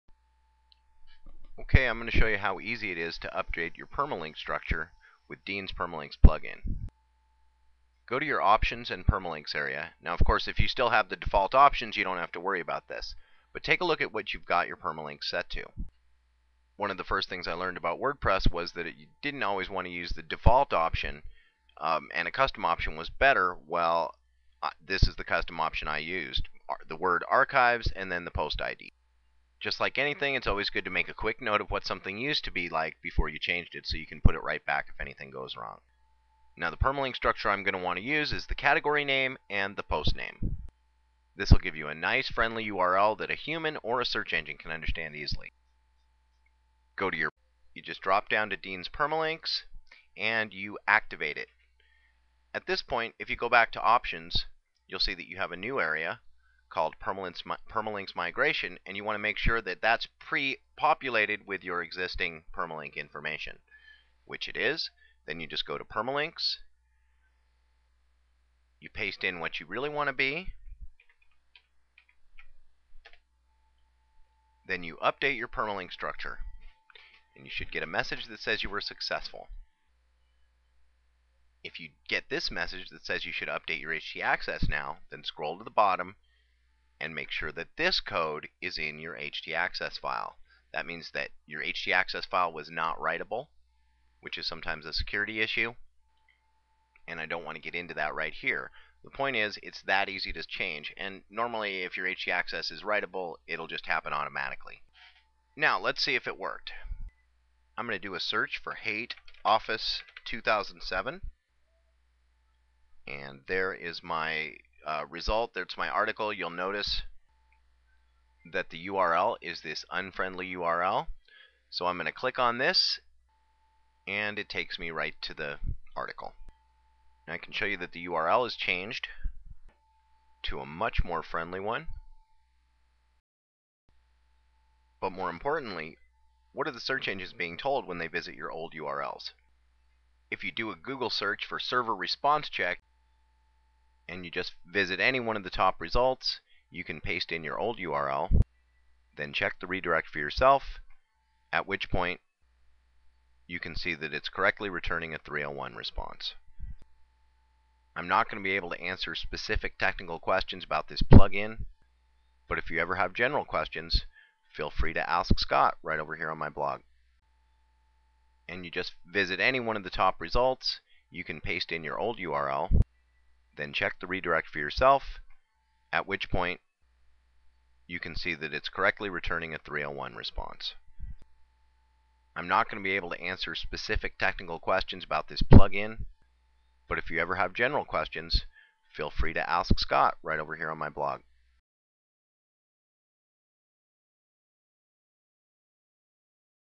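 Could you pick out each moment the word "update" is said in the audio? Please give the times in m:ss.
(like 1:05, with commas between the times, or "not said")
0:03, 1:15, 1:23.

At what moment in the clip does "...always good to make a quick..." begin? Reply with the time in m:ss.
0:30.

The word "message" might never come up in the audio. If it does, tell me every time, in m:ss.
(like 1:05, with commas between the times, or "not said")
1:17, 1:22.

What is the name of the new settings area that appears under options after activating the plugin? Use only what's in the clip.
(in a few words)
Permalinks Migration.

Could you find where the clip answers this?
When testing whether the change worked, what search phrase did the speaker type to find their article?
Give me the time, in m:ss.
1:48.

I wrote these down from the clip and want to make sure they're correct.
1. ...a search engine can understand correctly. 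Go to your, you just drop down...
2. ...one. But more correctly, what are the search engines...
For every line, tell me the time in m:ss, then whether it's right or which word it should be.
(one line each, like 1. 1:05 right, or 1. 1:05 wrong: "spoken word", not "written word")
1. 0:44 wrong: "easily", not "correctly"
2. 2:11 wrong: "importantly", not "correctly".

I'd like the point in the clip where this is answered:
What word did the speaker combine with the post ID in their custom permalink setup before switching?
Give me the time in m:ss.
0:26.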